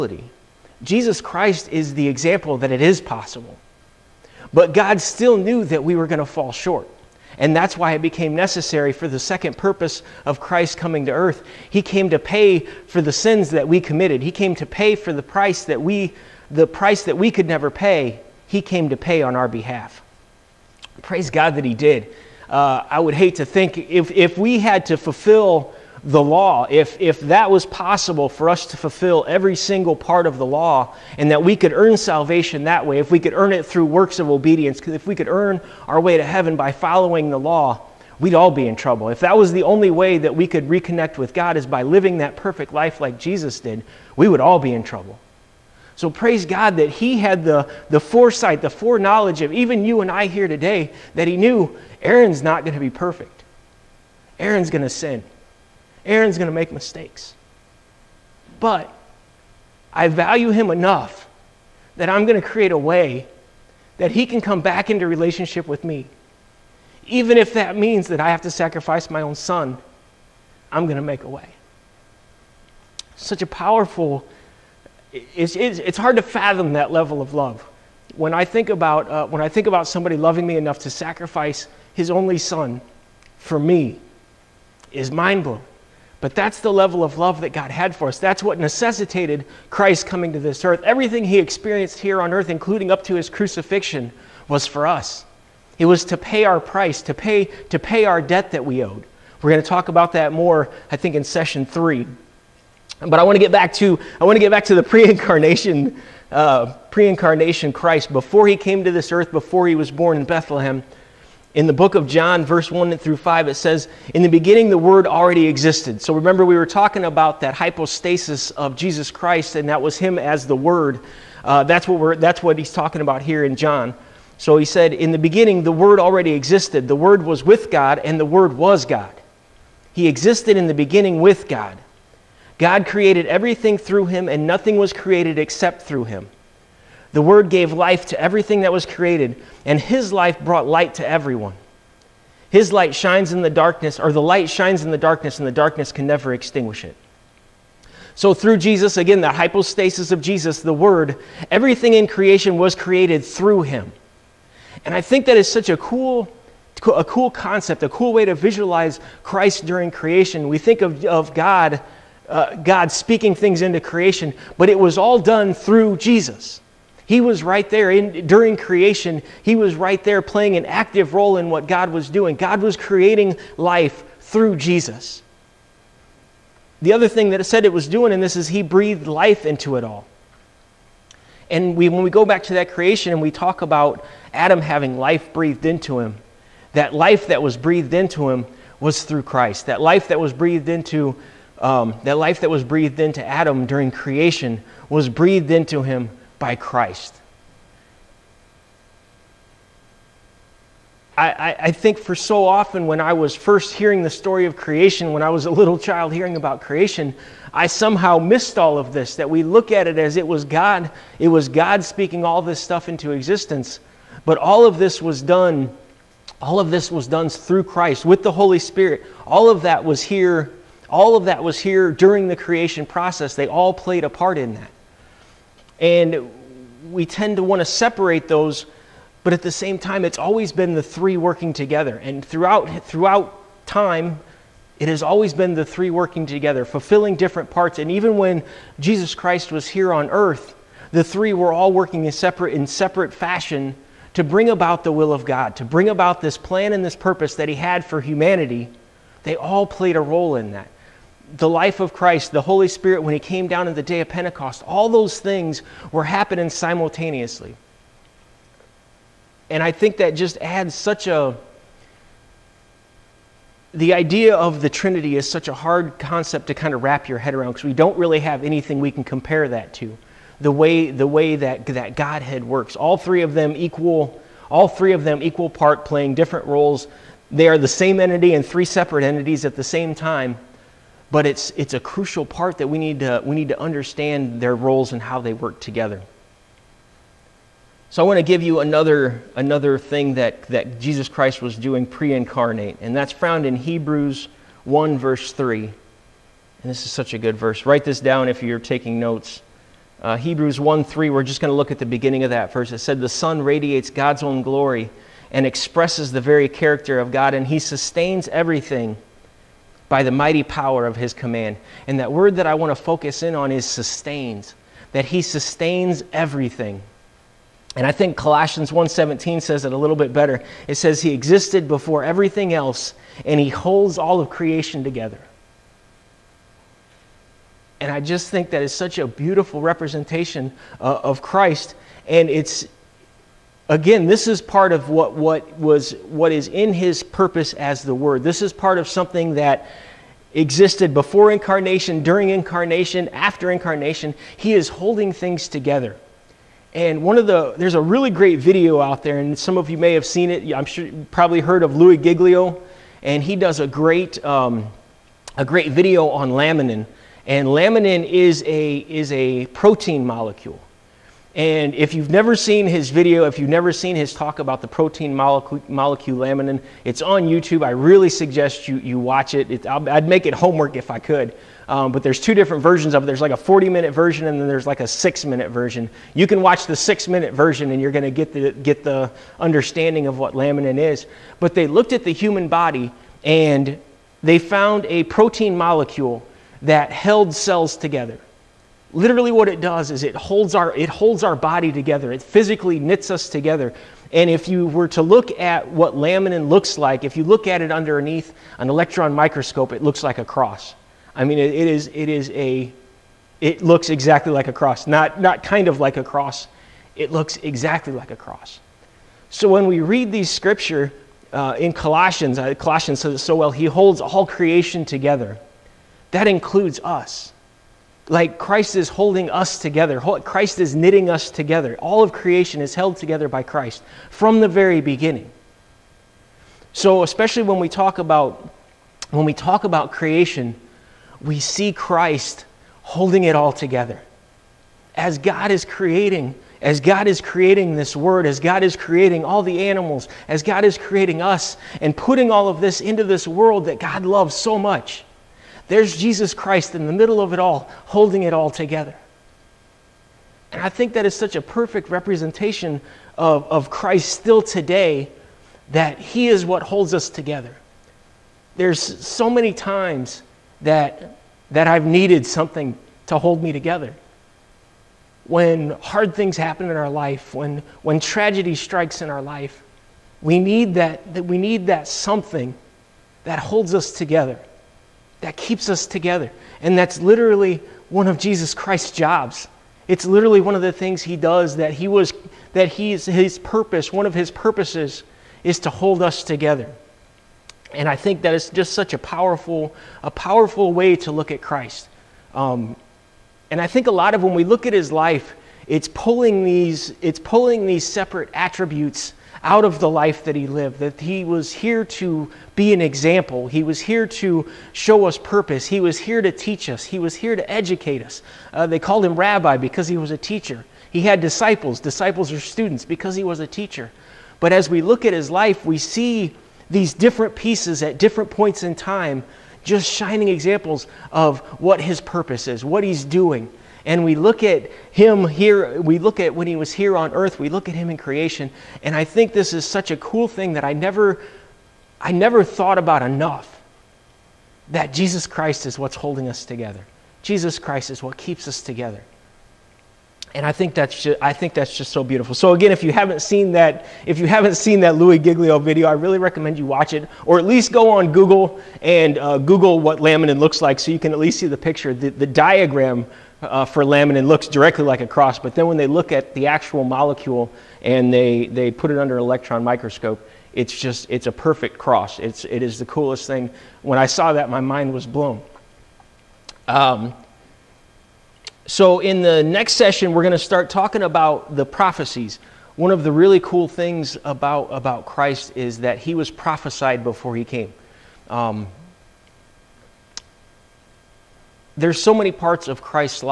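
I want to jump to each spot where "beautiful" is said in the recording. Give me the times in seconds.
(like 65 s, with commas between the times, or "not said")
329 s, 542 s.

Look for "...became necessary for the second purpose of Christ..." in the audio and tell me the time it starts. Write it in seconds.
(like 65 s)
8 s.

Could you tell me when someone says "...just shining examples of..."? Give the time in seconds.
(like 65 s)
519 s.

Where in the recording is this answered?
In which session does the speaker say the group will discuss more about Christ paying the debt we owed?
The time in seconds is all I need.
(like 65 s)
101 s.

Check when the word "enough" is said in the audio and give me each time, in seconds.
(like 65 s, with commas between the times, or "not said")
60 s, 80 s, 533 s.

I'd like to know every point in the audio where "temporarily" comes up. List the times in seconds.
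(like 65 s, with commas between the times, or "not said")
not said.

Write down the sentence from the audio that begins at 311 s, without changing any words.
And that word that I want to focus in on is sustains, that he sustains everything.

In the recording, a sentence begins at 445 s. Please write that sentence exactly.
There's Jesus Christ in the middle of it all, holding it all together.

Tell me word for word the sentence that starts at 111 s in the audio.
In the book of John, verse 1 through 5, it says, In the beginning, the Word already existed.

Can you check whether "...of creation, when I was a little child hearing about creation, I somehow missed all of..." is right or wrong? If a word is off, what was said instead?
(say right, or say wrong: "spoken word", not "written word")
right.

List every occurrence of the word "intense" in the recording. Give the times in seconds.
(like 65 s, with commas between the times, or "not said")
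not said.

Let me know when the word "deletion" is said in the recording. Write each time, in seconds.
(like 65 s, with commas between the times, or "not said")
not said.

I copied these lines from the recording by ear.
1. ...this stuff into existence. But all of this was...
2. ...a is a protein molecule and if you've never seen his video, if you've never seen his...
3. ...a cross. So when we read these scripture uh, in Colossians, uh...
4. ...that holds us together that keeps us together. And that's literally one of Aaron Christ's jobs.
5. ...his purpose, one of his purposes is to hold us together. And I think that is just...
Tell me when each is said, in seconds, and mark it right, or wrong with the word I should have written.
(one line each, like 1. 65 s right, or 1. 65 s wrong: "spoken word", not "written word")
1. 212 s right
2. 358 s right
3. 408 s right
4. 473 s wrong: "Jesus", not "Aaron"
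5. 483 s right.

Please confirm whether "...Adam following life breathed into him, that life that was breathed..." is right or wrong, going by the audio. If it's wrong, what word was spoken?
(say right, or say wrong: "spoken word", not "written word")
wrong: "having", not "following".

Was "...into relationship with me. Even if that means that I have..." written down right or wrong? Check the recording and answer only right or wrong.
right.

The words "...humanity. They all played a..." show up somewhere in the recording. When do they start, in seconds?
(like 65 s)
247 s.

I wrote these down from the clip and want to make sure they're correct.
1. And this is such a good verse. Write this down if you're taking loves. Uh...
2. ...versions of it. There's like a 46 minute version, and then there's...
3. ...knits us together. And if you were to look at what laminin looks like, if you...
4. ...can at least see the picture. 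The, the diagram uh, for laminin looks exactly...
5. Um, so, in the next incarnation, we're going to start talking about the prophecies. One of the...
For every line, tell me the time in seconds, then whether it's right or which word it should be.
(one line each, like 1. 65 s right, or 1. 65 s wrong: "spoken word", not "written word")
1. 295 s wrong: "notes", not "loves"
2. 372 s wrong: "40", not "46"
3. 392 s right
4. 550 s wrong: "directly", not "exactly"
5. 566 s wrong: "session", not "incarnation".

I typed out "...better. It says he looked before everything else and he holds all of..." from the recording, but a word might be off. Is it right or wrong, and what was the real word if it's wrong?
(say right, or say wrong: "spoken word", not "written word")
wrong: "existed", not "looked".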